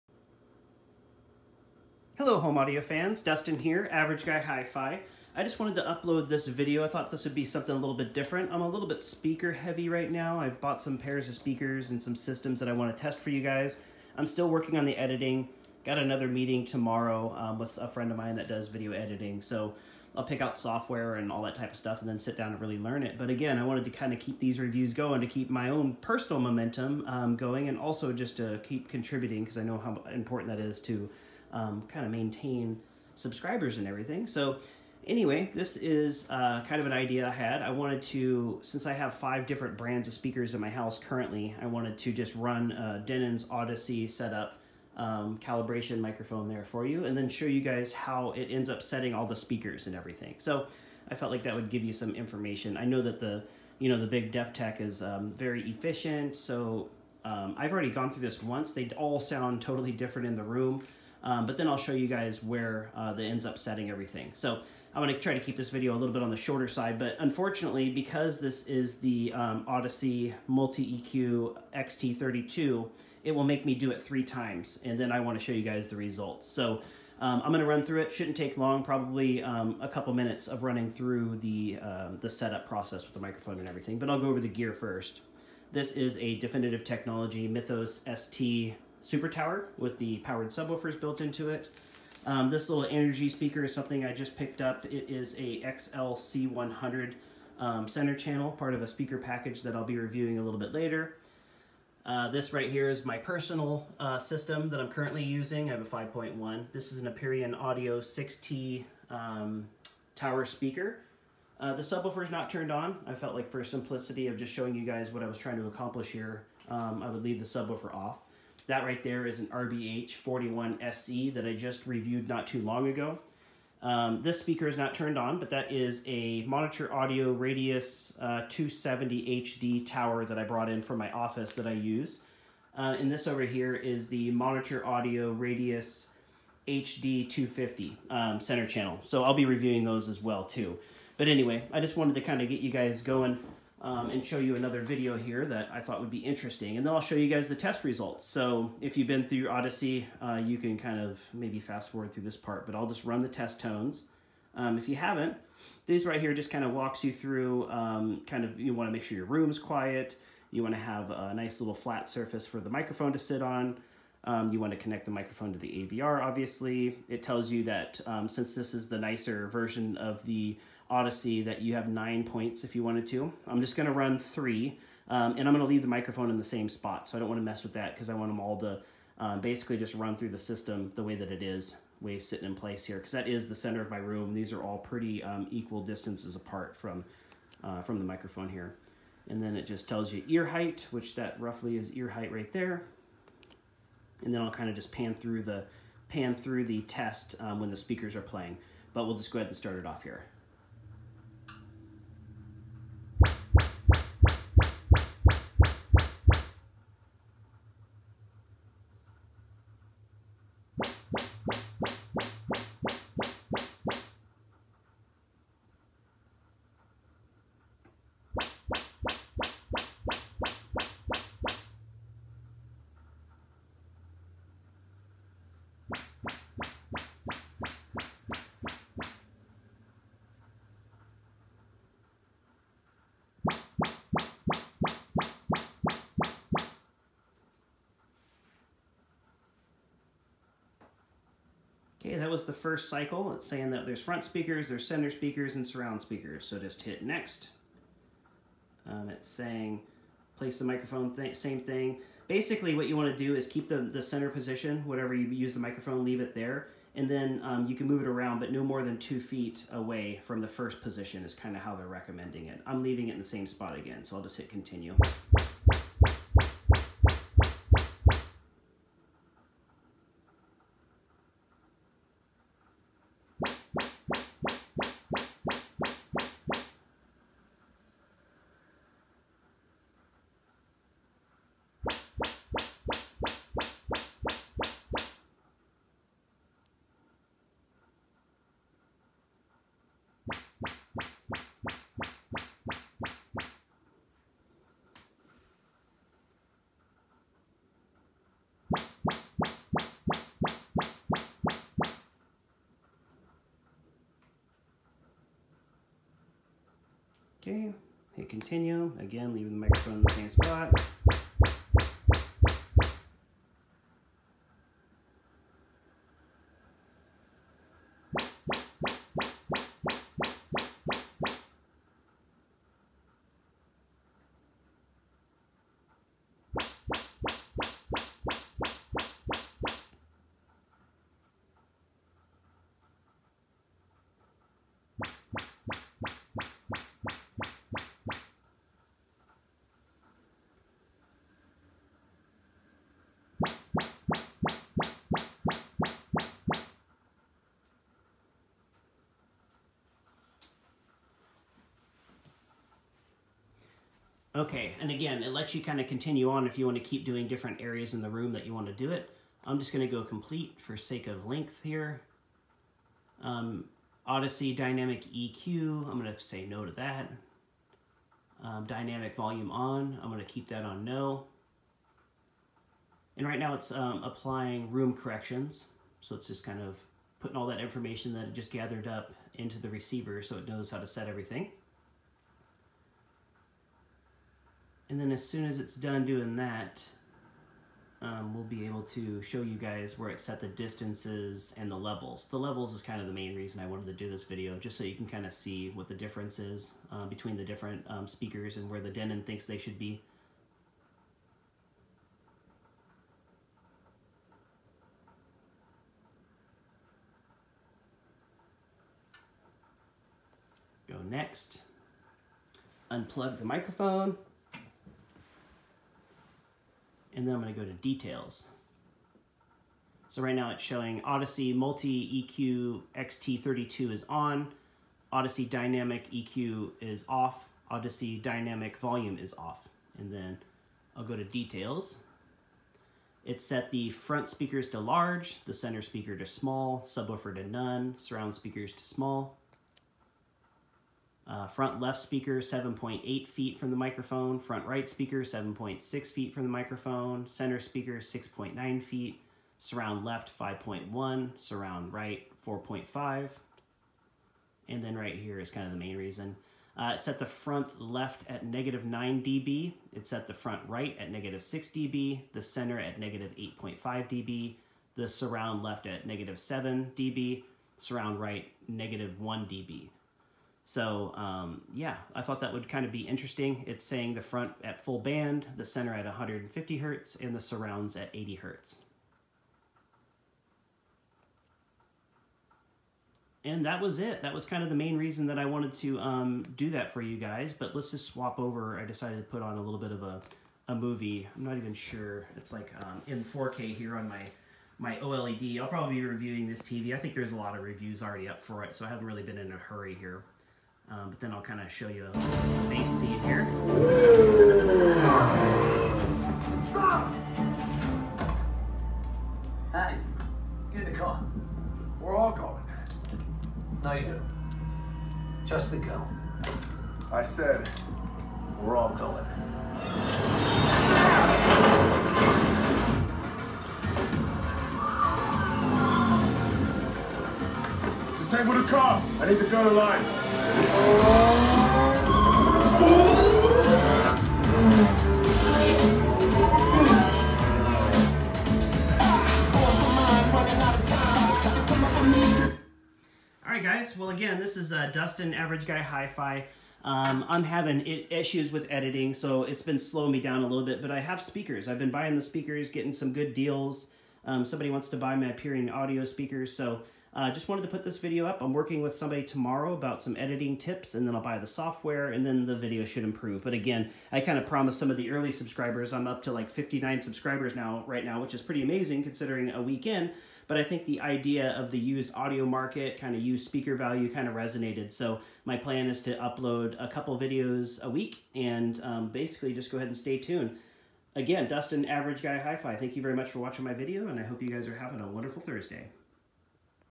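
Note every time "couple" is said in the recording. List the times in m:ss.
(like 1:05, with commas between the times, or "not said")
1:19, 9:36.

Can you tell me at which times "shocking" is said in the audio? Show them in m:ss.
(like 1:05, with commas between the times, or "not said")
not said.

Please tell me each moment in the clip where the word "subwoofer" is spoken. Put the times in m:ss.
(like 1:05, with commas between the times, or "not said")
1:30, 1:51, 1:57, 7:16.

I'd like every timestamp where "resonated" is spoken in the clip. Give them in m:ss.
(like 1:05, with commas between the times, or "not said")
9:34.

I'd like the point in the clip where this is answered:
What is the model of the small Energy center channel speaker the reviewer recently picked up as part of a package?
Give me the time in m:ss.
1:35.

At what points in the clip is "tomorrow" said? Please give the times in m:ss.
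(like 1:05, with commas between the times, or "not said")
0:16, 9:19.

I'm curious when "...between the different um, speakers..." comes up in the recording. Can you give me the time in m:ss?
6:37.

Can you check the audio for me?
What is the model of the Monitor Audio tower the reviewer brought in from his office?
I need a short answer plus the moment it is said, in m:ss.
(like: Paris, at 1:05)
Radius 270 HD, at 2:07.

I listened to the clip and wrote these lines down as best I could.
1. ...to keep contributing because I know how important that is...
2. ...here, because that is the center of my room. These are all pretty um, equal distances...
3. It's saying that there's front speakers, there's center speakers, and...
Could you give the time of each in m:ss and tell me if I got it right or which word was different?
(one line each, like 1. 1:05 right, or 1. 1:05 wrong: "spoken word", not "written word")
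1. 0:28 right
2. 3:02 right
3. 4:03 right.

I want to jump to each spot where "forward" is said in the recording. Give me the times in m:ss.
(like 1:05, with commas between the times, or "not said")
2:31.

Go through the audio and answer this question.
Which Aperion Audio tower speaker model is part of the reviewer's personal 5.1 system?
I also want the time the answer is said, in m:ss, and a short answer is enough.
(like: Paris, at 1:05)
6T, at 1:48.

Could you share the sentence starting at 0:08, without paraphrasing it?
I'm a little bit speaker heavy right now.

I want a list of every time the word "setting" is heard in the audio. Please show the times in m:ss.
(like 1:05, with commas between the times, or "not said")
0:48, 1:03.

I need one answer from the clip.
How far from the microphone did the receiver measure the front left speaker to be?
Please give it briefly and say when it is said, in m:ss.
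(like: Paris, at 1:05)
7.8 feet, at 7:22.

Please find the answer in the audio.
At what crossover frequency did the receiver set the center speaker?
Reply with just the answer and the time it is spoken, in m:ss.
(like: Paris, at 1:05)
150 hertz, at 7:56.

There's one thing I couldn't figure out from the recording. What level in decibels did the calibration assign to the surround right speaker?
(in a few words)
-1 dB.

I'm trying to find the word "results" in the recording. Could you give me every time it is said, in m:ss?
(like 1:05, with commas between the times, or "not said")
1:15, 2:27.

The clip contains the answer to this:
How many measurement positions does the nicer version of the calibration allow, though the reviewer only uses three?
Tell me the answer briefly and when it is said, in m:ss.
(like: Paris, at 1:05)
9, at 2:51.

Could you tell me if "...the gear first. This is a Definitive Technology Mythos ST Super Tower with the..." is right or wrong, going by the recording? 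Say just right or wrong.
right.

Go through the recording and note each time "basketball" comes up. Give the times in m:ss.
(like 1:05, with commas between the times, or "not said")
not said.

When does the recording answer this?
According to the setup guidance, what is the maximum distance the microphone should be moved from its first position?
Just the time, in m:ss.
4:18.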